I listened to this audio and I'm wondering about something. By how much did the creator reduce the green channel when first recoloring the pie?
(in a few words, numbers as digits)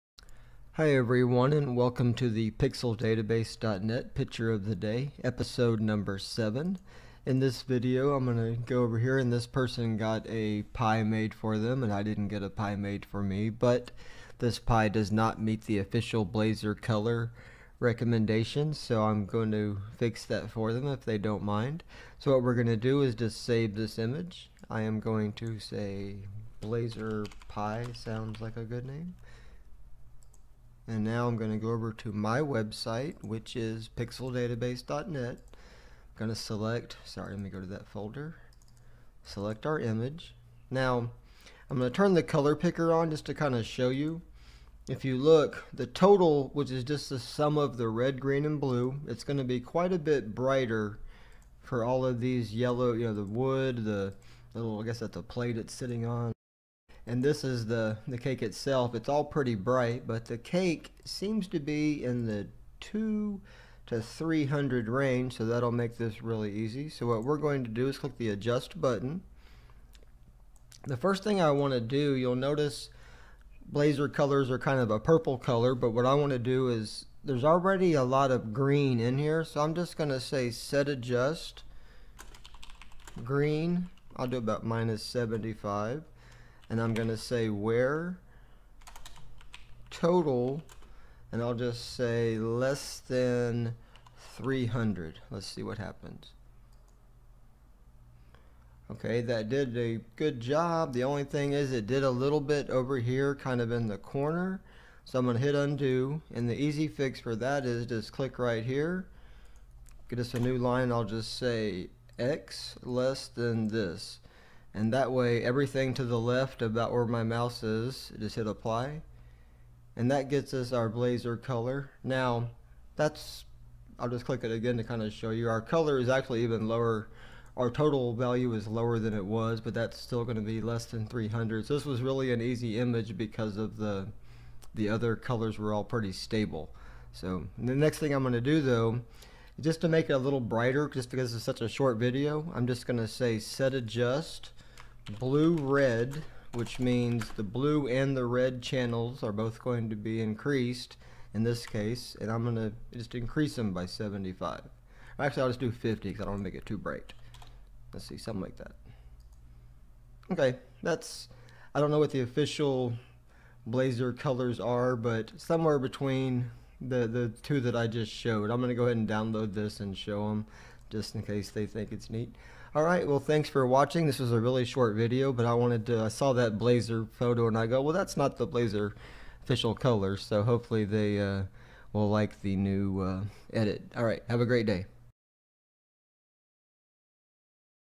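-75.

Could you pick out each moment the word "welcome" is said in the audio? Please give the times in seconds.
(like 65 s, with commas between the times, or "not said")
1 s.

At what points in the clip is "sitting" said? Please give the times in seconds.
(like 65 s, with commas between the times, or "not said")
55 s.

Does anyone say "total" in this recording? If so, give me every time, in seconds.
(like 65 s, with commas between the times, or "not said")
45 s, 89 s, 127 s.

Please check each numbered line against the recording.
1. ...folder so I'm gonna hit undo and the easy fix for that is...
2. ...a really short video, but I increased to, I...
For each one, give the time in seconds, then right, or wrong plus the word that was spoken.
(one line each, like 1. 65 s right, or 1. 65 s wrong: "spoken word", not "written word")
1. 103 s wrong: "corner", not "folder"
2. 174 s wrong: "wanted", not "increased".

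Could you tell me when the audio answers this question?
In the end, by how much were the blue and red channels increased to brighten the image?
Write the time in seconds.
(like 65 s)
155 s.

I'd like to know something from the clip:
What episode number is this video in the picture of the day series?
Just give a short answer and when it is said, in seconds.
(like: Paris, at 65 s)
7, at 6 s.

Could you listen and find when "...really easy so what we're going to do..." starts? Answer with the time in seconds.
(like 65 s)
66 s.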